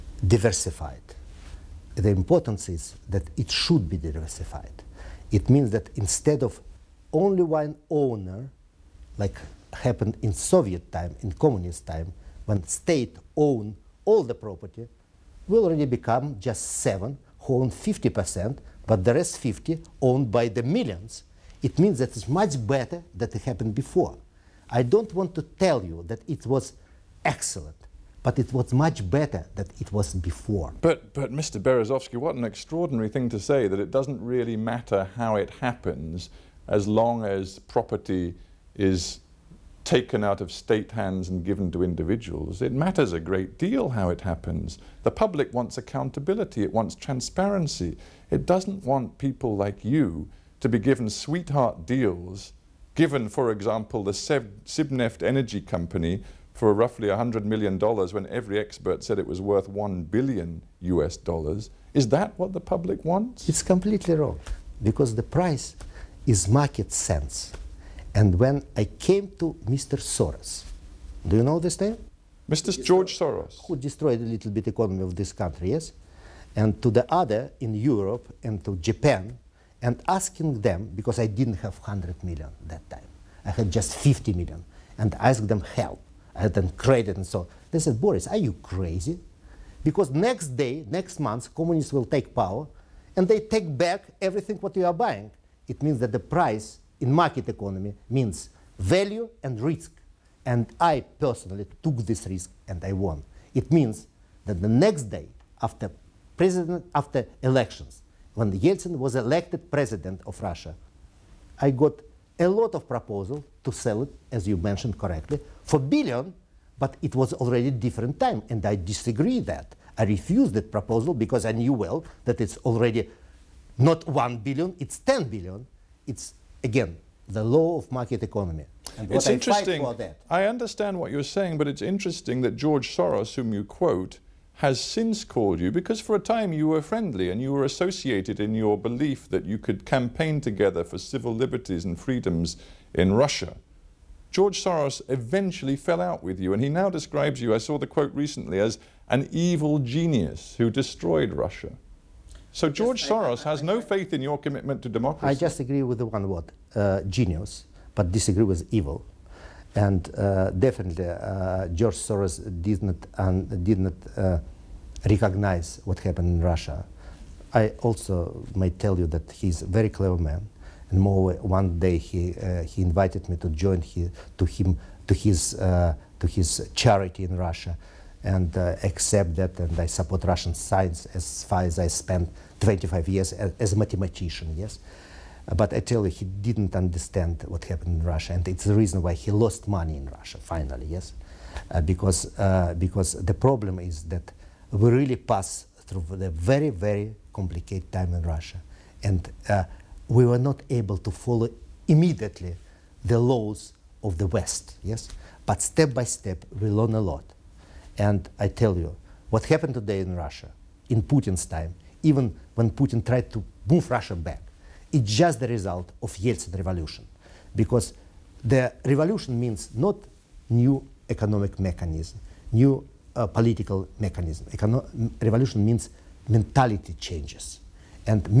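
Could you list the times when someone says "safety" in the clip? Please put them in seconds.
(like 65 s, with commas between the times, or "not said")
not said.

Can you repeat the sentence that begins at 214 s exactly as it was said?
It's just the result of Yeltsin revolution, because the revolution means not new economic mechanism, new uh, political mechanism.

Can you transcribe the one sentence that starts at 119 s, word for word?
I refused that proposal because I knew well that it's already not 1 billion, it's 10 billion.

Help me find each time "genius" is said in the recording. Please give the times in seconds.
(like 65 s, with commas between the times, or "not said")
149 s, 157 s.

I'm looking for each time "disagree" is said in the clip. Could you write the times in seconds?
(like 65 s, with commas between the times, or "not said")
118 s, 158 s.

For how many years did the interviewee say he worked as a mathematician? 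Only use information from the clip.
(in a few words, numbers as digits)
25.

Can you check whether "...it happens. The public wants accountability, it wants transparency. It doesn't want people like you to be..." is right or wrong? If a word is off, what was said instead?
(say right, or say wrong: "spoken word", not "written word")
right.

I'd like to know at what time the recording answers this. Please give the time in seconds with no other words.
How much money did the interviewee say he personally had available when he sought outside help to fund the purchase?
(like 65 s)
83 s.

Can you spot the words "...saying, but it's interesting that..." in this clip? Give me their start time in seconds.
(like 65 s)
131 s.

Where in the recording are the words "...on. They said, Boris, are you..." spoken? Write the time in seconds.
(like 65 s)
87 s.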